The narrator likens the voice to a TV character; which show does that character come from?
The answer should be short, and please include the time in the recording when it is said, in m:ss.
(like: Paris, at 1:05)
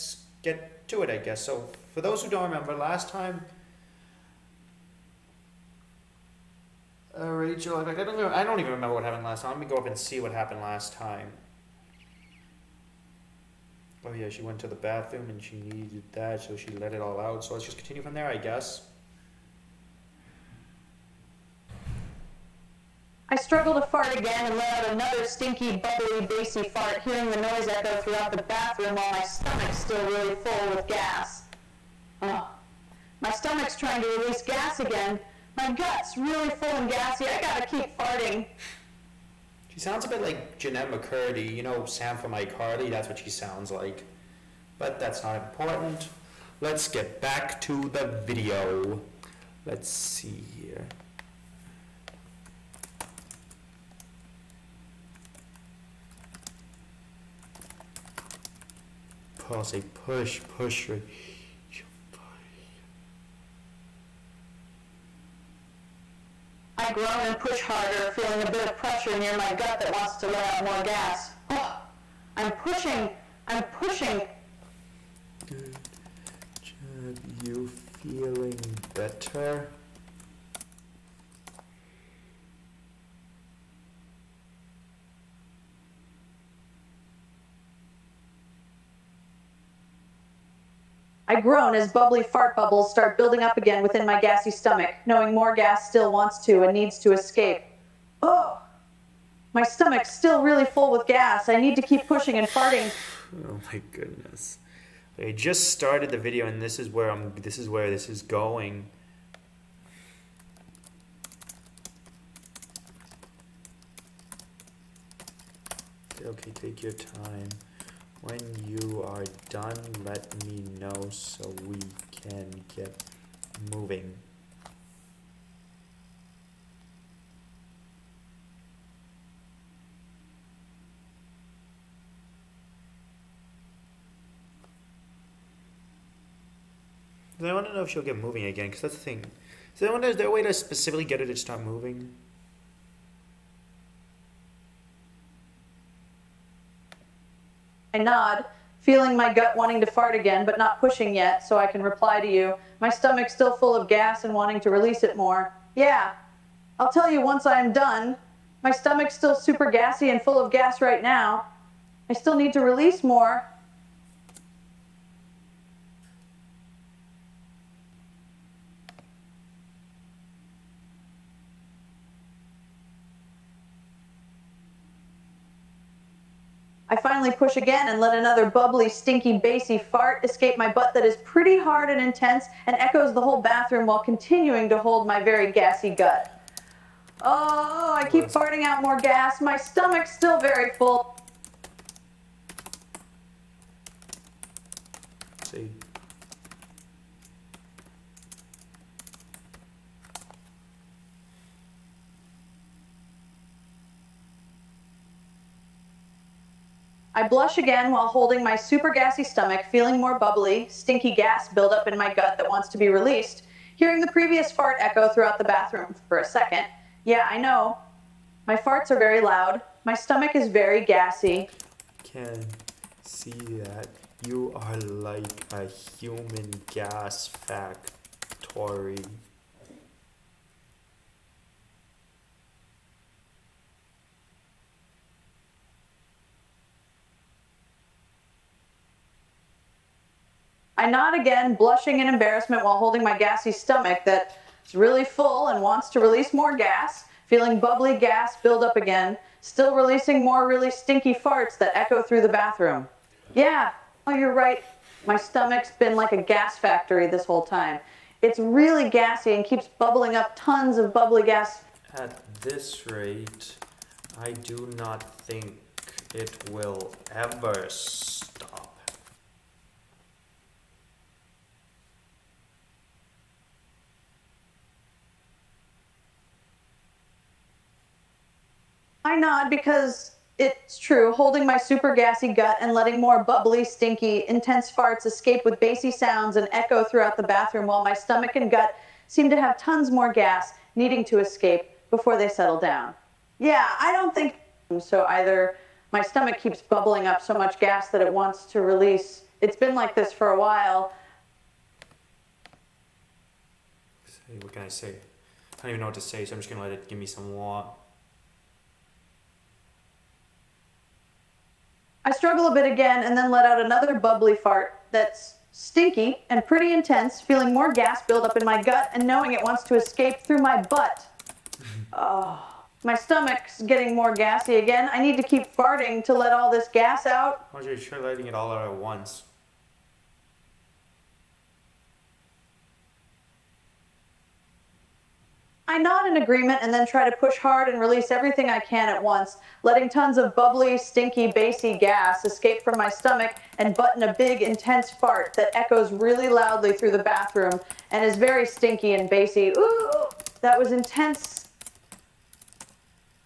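iCarly, at 0:42.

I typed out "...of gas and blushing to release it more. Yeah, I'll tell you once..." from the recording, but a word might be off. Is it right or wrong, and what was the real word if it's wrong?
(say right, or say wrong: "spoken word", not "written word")
wrong: "wanting", not "blushing".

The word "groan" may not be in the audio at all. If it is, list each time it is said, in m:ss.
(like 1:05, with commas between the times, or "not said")
1:06, 1:31.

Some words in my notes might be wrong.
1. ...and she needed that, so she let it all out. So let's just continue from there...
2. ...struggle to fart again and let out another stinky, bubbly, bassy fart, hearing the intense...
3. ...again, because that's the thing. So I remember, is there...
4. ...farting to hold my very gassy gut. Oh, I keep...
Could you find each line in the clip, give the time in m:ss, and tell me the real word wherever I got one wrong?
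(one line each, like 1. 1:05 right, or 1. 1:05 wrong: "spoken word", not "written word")
1. 0:15 right
2. 0:23 wrong: "noise", not "intense"
3. 2:18 wrong: "wonder", not "remember"
4. 3:03 wrong: "continuing", not "farting".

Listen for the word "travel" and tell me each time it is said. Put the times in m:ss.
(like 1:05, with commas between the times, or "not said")
not said.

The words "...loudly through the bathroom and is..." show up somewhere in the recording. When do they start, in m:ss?
5:46.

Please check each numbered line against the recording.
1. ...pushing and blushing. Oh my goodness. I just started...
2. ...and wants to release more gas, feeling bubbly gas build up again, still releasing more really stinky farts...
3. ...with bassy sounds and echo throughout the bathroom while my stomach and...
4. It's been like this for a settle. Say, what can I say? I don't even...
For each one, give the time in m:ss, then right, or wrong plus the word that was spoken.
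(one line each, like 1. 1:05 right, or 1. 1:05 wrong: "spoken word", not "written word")
1. 1:42 wrong: "farting", not "blushing"
2. 4:05 right
3. 4:45 right
4. 4:59 wrong: "while", not "settle".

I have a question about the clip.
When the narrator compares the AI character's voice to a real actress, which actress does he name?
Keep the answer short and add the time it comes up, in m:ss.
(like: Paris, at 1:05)
Jennette McCurdy, at 0:40.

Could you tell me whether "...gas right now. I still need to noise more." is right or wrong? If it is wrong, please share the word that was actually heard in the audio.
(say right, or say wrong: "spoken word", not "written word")
wrong: "release", not "noise".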